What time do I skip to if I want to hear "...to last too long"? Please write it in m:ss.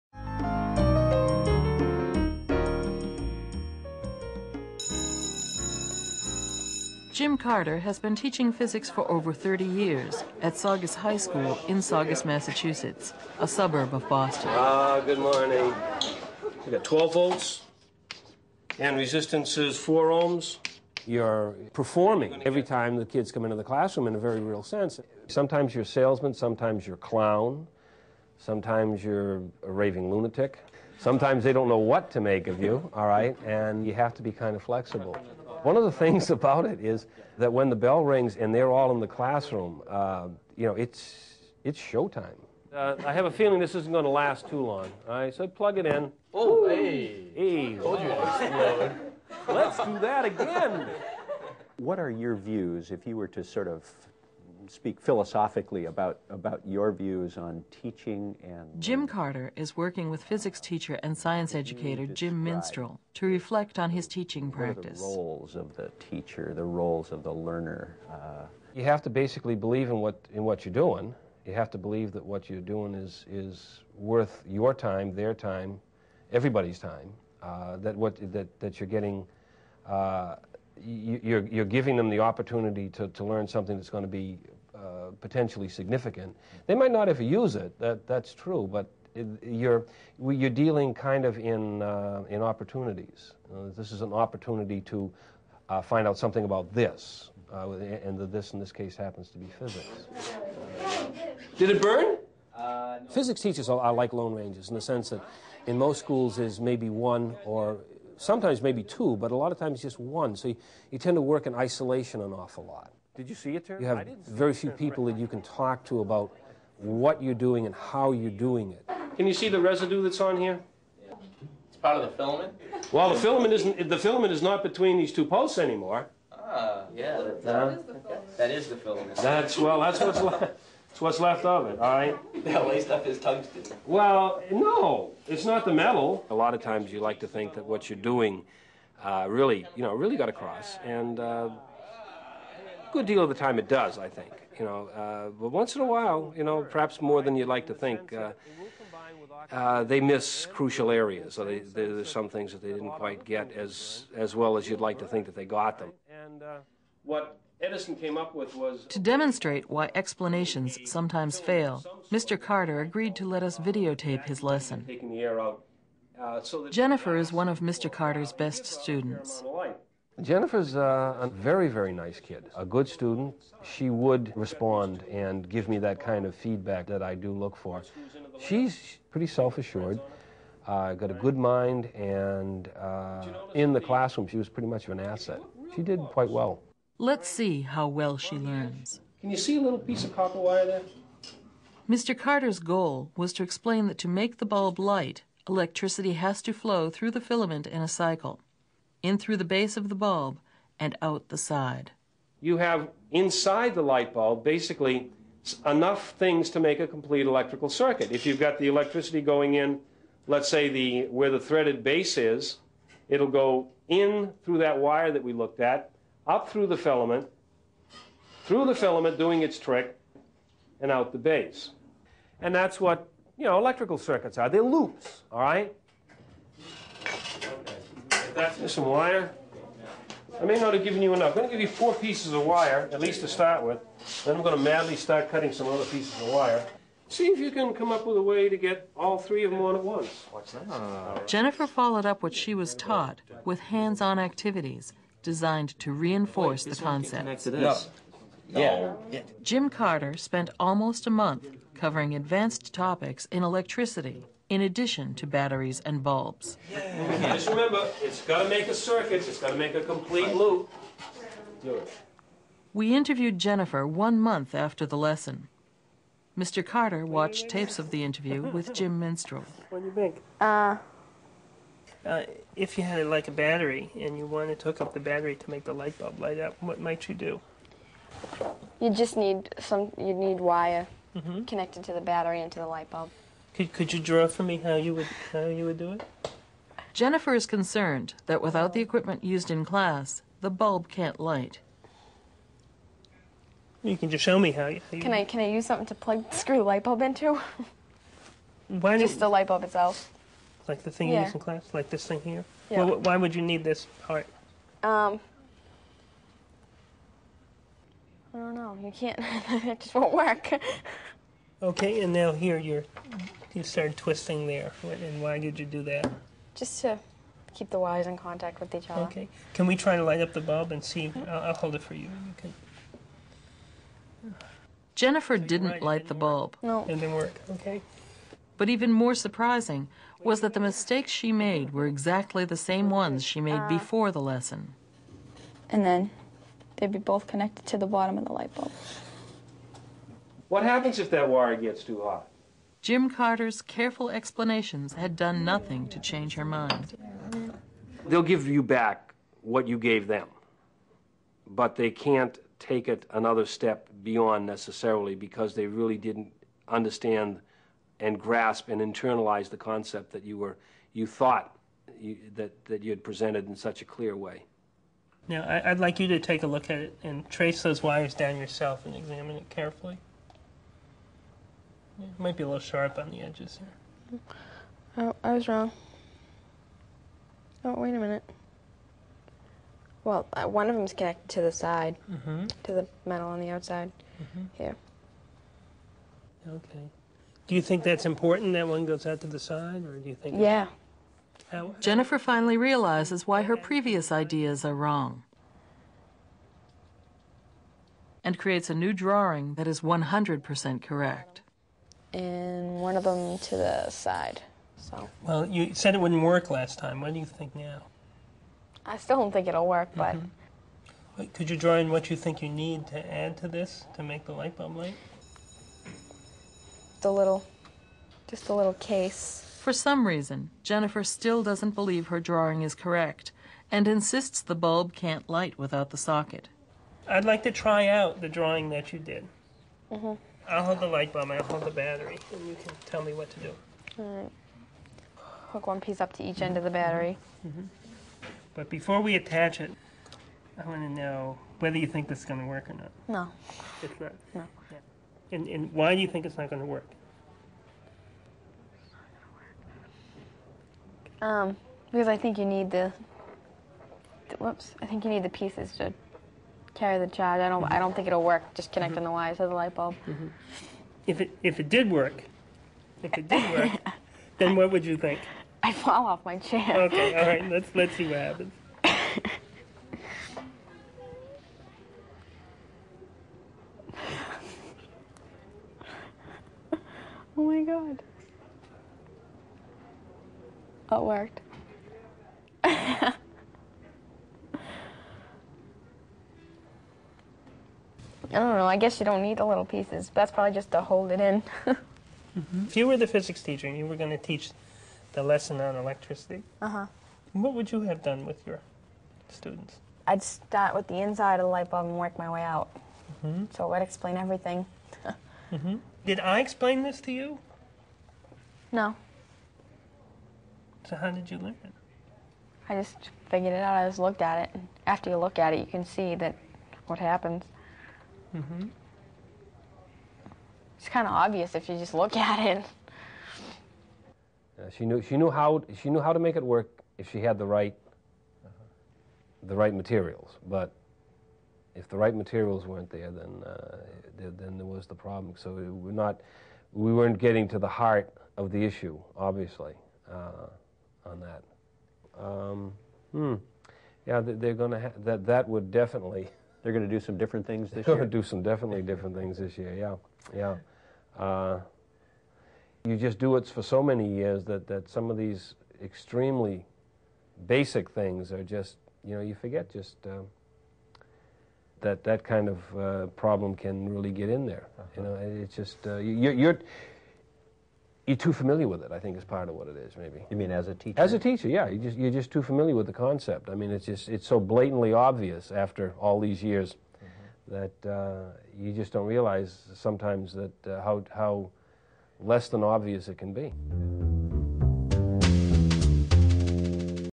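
0:44.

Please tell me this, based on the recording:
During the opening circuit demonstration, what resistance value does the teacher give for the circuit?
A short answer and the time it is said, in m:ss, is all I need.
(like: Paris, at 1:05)
4 ohms, at 0:19.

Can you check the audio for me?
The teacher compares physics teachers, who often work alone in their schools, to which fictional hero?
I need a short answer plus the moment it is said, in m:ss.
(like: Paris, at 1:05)
Lone Rangers, at 1:44.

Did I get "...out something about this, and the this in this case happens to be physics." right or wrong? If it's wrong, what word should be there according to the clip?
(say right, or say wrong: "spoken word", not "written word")
right.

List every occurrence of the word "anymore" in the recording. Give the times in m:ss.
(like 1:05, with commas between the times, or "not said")
2:05.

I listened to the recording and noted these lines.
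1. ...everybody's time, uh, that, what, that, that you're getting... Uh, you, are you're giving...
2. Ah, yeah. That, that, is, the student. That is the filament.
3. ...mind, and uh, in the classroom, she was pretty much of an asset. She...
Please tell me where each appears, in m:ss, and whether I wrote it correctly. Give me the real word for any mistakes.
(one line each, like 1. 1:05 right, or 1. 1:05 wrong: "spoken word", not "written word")
1. 1:16 right
2. 2:06 wrong: "filament", not "student"
3. 3:01 right.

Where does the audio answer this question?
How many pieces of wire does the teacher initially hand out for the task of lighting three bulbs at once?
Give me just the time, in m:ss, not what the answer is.
3:51.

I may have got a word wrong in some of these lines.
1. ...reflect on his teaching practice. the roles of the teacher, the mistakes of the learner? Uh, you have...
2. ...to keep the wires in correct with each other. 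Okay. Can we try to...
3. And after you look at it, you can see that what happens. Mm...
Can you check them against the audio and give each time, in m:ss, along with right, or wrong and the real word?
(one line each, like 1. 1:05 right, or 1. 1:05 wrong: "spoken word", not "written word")
1. 1:03 wrong: "roles", not "mistakes"
2. 5:16 wrong: "contact", not "correct"
3. 8:34 right.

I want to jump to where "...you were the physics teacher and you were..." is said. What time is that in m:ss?
8:12.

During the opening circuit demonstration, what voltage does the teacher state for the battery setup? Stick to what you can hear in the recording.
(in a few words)
12 volts.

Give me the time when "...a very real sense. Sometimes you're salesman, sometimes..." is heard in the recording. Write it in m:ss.
0:24.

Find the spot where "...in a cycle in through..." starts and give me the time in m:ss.
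3:17.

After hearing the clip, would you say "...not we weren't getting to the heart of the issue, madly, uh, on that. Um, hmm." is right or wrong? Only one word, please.
wrong.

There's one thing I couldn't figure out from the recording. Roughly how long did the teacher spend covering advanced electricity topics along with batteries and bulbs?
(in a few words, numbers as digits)
almost a month.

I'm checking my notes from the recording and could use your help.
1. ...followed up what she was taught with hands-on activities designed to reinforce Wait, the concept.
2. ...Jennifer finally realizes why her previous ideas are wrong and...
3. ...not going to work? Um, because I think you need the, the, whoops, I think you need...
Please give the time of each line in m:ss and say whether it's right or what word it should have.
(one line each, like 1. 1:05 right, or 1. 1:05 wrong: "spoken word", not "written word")
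1. 4:01 right
2. 6:31 right
3. 7:26 right.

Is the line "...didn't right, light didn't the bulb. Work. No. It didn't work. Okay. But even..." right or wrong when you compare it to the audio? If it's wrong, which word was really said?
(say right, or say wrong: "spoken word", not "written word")
right.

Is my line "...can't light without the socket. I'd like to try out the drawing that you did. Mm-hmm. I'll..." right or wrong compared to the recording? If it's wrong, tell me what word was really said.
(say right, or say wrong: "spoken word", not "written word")
right.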